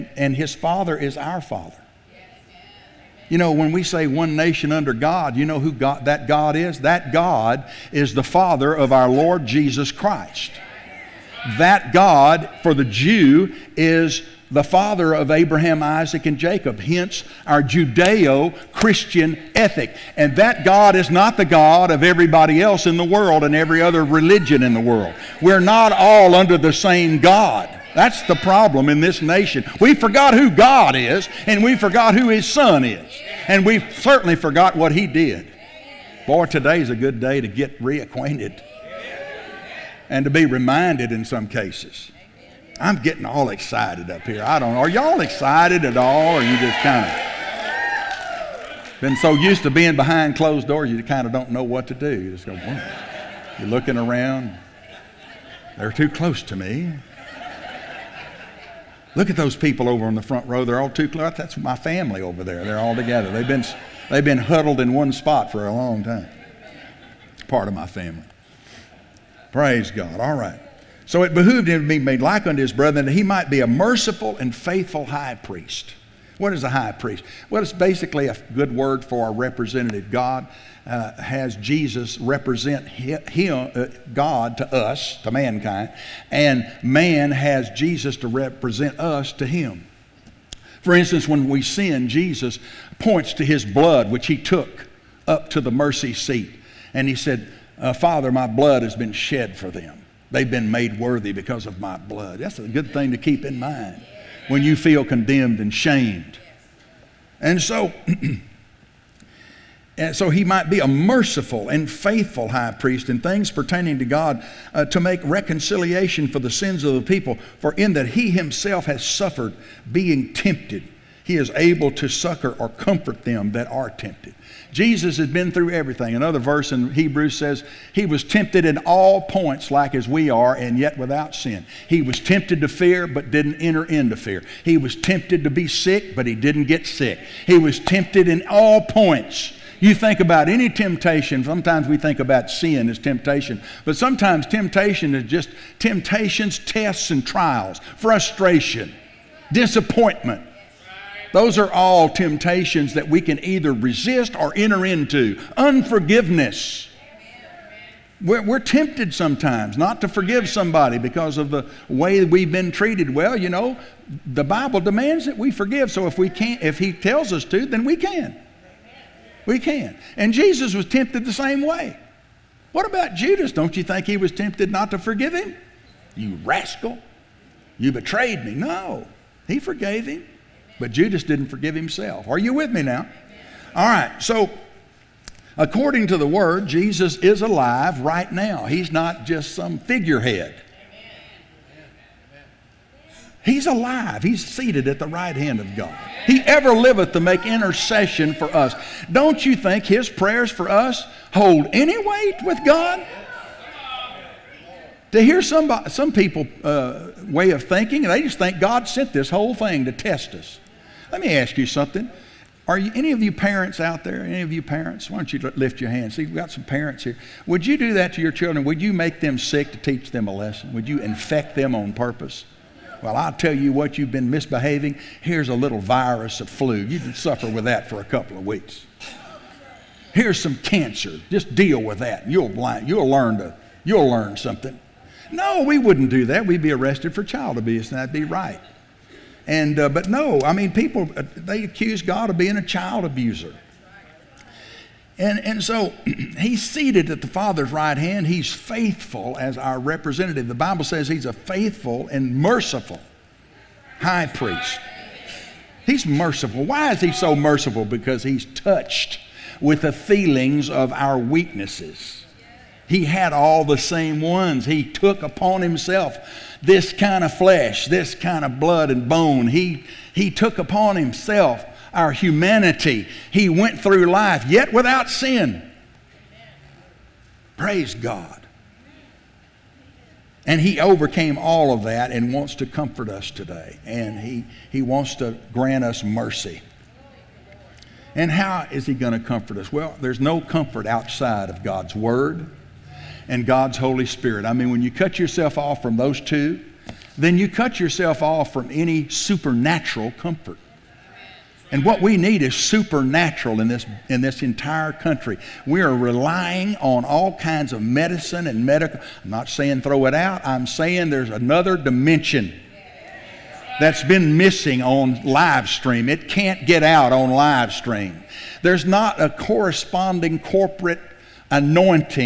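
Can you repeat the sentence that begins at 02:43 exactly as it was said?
Well, you know, the Bible demands that we forgive.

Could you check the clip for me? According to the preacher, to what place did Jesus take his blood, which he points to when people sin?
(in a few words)
the mercy seat.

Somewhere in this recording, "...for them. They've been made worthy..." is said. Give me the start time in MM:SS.
01:39.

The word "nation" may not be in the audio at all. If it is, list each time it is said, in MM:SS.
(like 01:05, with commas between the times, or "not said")
00:04, 00:29.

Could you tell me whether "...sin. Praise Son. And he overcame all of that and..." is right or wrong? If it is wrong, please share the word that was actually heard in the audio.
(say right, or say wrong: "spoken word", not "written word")
wrong: "God", not "Son".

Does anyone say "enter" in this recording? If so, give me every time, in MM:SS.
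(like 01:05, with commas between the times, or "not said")
02:13, 02:34.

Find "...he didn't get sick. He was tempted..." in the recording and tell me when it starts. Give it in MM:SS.
02:16.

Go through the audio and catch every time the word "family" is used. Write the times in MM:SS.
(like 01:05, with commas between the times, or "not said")
01:01, 01:07.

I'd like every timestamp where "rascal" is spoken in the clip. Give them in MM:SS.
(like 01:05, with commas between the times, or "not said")
02:56.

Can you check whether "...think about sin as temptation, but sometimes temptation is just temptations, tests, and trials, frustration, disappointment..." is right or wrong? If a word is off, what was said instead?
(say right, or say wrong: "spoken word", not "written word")
right.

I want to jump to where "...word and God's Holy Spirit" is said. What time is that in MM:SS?
04:51.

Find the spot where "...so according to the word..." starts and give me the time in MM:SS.
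03:04.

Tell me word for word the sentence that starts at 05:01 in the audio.
And what we need is supernatural in this, in this entire country.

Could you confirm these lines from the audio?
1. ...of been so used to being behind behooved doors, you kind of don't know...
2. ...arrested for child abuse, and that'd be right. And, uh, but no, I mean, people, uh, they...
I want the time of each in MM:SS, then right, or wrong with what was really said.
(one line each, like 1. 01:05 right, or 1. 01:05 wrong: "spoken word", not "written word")
1. 00:47 wrong: "closed", not "behooved"
2. 03:56 right.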